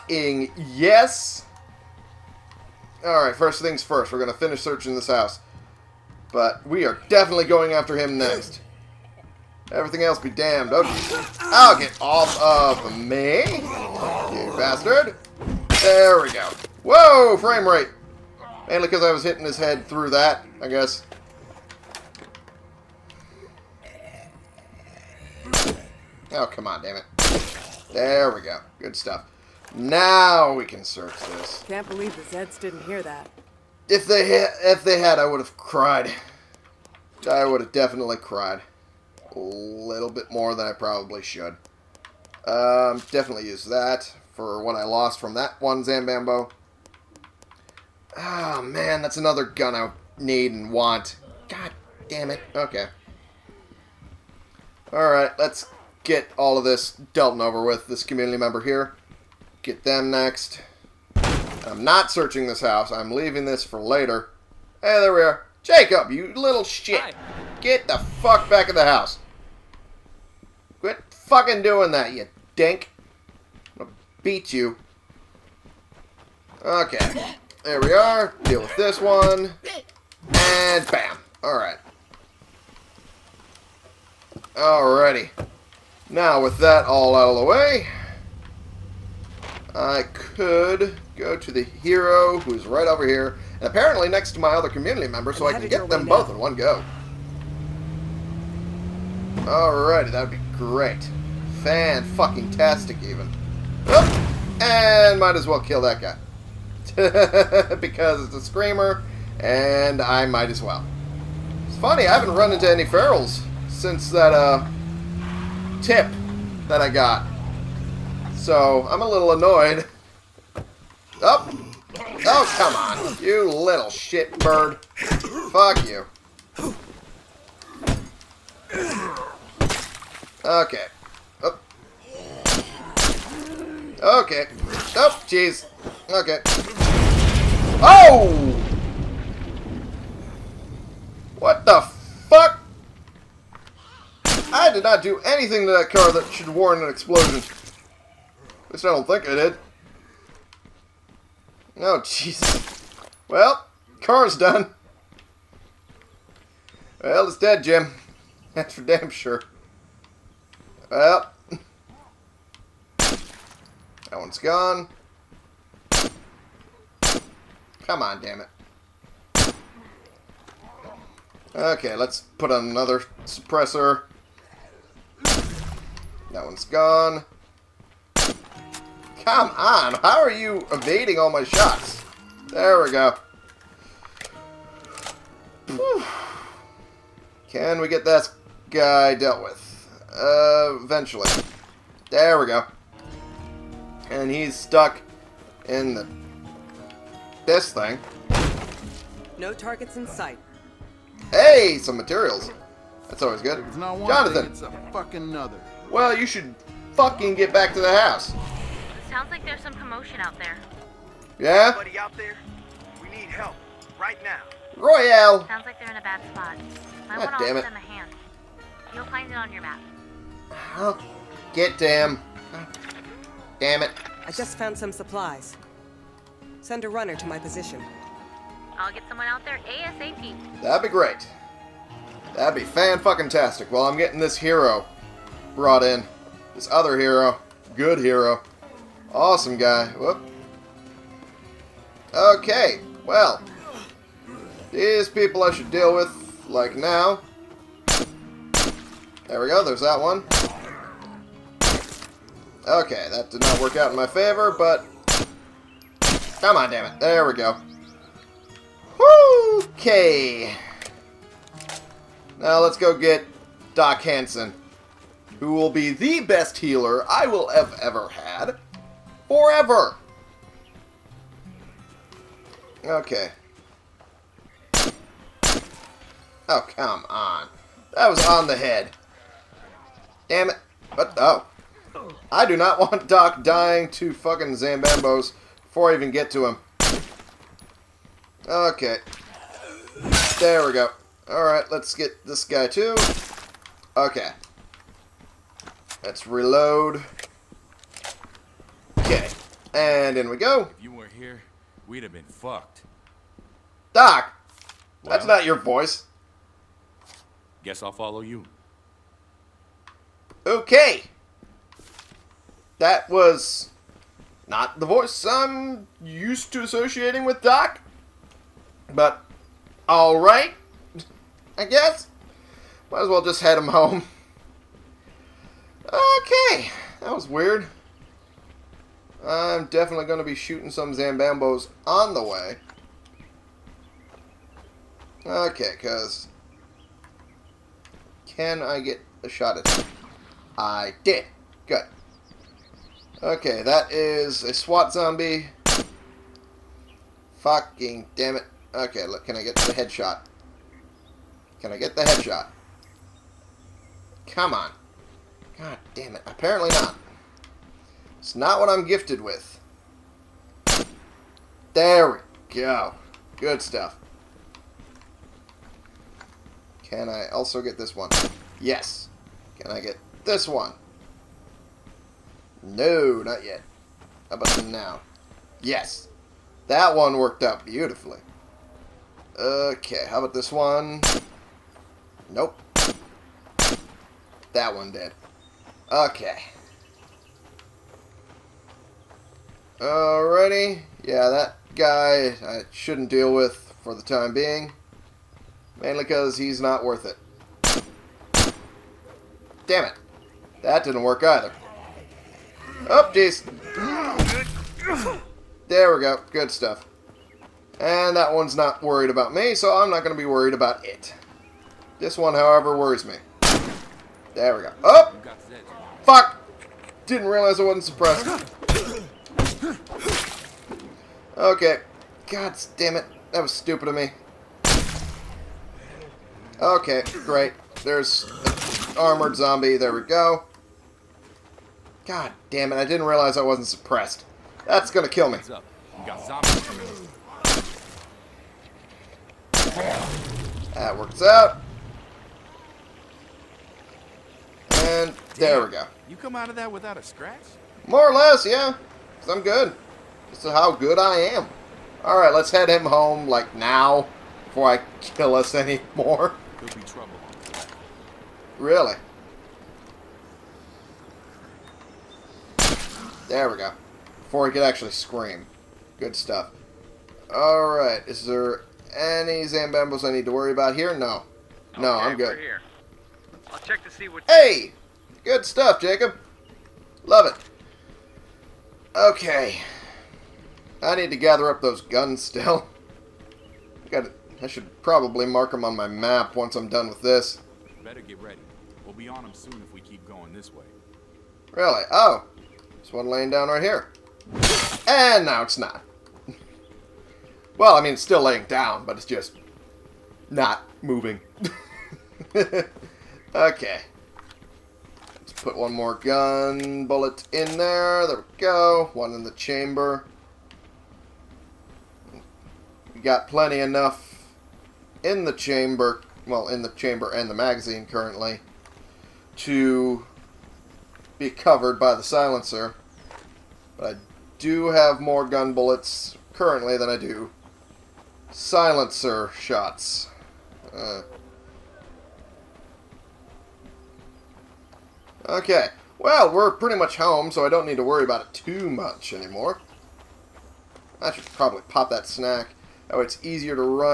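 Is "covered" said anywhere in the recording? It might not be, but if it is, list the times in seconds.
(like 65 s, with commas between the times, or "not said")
521 s.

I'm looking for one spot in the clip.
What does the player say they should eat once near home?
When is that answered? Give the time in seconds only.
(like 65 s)
542 s.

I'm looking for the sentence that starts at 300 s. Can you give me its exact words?
If you were here, we'd have been fucked.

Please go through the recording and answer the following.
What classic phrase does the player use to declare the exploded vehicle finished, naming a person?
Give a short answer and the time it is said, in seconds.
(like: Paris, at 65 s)
It's dead, Jim, at 157 s.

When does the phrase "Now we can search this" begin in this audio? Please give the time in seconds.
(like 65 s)
29 s.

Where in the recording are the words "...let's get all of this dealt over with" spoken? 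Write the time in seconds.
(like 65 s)
55 s.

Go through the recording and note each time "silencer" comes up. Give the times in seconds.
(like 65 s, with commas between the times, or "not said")
522 s, 528 s.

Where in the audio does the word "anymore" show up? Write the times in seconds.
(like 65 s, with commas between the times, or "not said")
455 s, 539 s.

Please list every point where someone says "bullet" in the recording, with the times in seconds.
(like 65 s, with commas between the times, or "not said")
506 s, 525 s.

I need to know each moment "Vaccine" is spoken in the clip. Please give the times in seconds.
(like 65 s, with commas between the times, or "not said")
not said.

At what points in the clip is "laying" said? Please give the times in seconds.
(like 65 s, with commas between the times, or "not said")
493 s, 498 s.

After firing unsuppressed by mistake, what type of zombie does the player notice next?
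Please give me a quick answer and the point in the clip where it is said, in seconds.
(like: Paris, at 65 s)
Armored zombie, at 428 s.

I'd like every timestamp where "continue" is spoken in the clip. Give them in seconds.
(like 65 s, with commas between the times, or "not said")
not said.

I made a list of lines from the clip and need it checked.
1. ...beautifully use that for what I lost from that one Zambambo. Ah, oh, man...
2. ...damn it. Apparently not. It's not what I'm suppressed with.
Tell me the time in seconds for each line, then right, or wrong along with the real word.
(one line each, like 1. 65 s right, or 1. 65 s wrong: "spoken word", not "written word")
1. 43 s wrong: "definitely", not "beautifully"
2. 355 s wrong: "gifted", not "suppressed".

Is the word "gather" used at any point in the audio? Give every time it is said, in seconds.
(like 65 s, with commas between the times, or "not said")
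481 s.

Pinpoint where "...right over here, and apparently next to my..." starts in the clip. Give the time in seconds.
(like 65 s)
92 s.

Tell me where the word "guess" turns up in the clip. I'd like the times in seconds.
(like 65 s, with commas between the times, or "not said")
20 s, 307 s, 321 s.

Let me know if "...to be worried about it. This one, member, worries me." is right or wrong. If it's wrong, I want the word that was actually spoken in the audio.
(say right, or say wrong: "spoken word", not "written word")
wrong: "however", not "member".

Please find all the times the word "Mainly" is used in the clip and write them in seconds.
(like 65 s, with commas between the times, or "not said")
18 s, 395 s.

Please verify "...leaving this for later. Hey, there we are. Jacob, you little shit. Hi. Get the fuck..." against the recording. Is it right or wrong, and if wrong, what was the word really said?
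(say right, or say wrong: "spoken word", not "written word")
right.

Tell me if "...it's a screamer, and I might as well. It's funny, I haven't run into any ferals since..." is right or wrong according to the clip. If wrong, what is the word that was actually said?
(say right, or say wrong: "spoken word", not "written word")
right.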